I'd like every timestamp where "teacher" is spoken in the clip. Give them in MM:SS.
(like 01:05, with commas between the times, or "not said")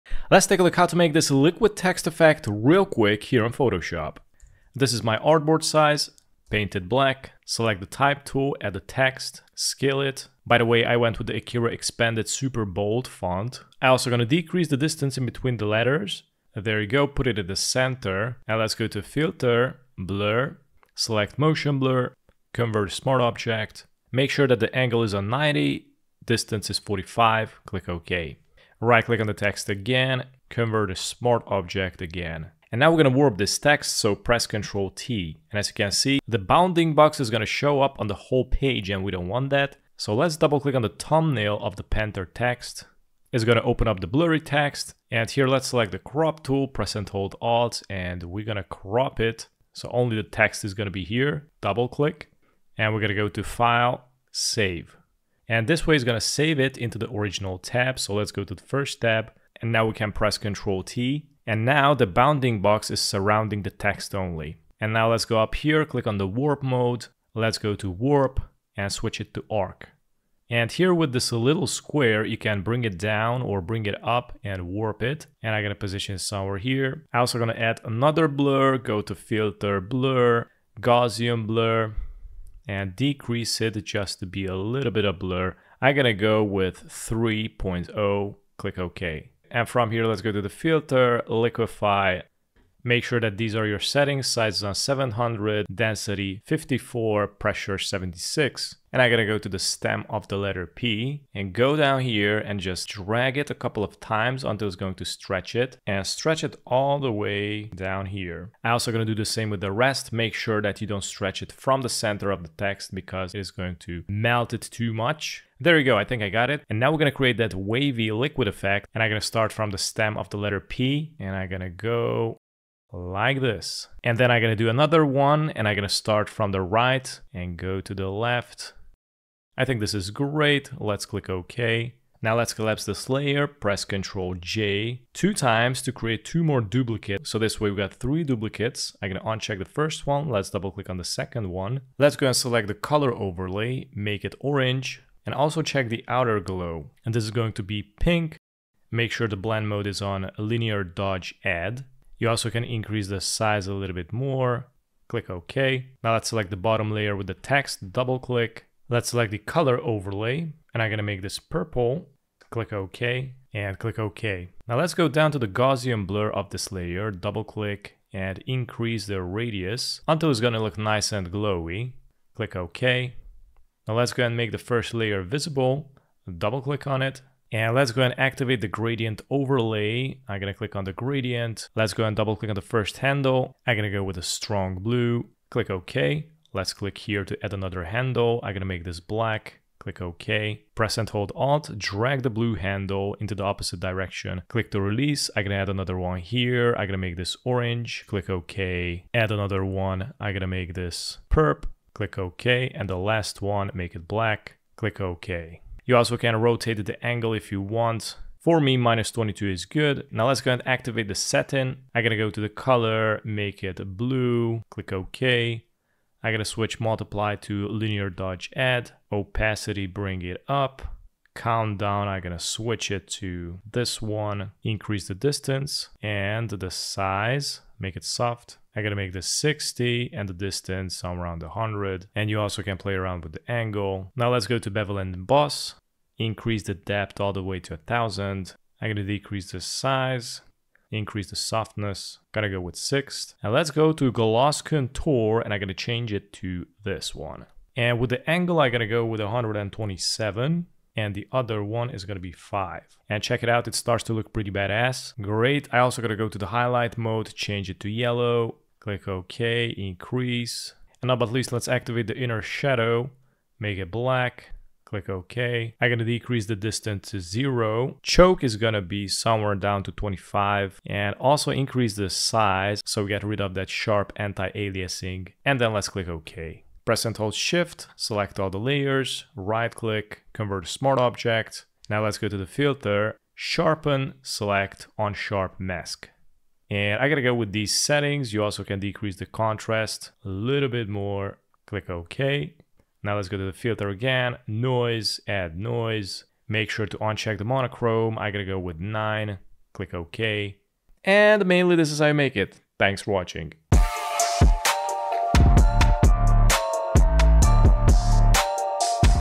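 not said.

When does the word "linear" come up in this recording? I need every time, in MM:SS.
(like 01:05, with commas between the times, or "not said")
02:30, 03:37.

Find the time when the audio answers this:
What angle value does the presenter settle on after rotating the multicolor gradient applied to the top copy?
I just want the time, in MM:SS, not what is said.
03:28.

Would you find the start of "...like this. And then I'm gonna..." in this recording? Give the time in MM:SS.
02:02.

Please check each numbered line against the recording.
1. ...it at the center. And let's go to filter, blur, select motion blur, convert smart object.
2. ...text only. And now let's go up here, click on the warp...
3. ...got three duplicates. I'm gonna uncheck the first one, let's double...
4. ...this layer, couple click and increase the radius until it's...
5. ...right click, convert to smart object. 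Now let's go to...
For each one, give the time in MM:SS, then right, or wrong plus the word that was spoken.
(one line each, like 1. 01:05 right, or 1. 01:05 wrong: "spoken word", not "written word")
1. 00:17 right
2. 01:03 right
3. 02:17 right
4. 02:46 wrong: "double", not "couple"
5. 04:39 right.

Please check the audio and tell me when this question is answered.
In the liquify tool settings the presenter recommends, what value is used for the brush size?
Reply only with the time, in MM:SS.
01:34.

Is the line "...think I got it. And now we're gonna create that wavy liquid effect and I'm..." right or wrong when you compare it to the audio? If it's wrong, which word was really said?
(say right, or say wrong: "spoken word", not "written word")
right.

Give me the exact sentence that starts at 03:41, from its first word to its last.
Countdown, I'm gonna switch it to this one, increase the distance and the size, make it soft.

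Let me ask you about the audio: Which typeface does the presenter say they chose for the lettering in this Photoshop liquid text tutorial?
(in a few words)
Akira expanded super bold.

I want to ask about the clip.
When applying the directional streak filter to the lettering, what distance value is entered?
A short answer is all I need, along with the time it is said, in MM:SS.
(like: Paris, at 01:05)
45, at 00:26.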